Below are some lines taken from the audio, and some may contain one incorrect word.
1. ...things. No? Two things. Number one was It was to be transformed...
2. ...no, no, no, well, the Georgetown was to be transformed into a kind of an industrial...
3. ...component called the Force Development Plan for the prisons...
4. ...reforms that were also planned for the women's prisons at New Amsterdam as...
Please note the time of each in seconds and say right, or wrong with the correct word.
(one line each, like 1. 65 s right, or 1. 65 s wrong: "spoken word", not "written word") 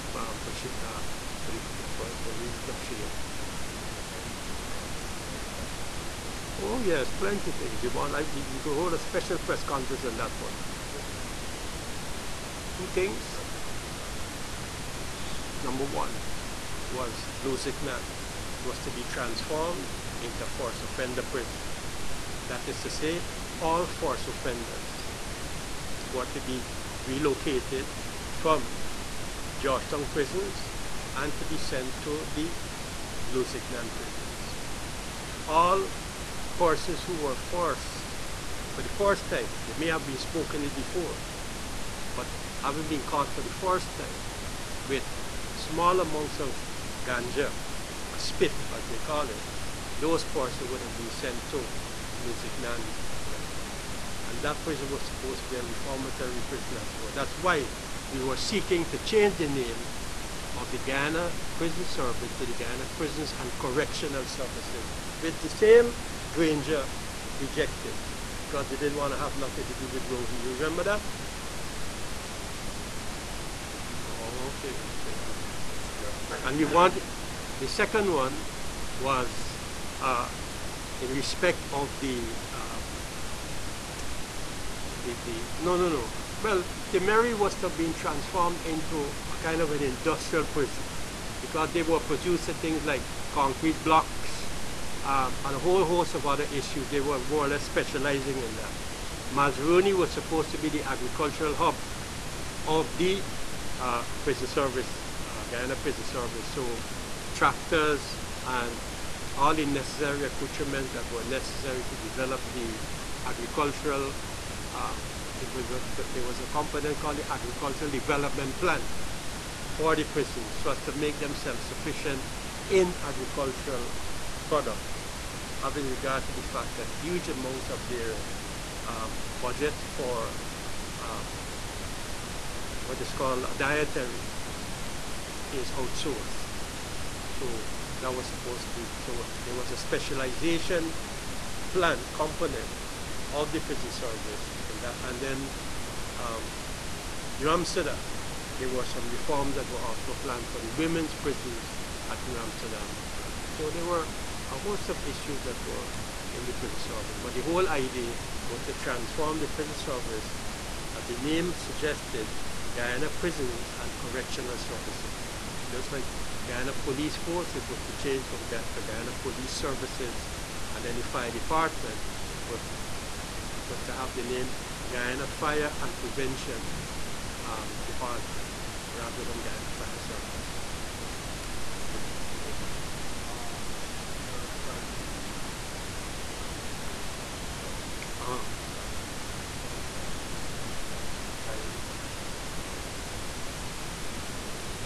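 1. 11 s right
2. 85 s wrong: "Mary", not "Georgetown"
3. 116 s wrong: "Agricultural", not "Force"
4. 149 s right.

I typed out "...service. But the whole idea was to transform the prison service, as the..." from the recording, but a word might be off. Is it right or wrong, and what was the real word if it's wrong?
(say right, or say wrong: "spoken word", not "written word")
right.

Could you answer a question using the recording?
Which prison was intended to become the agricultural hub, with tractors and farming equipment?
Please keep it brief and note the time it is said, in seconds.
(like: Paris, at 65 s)
Mazaruni, at 99 s.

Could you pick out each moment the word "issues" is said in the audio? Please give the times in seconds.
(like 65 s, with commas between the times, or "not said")
96 s, 155 s.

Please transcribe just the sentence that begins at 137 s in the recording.
So that was supposed to be, so there was a specialization plan component of the prison service in that.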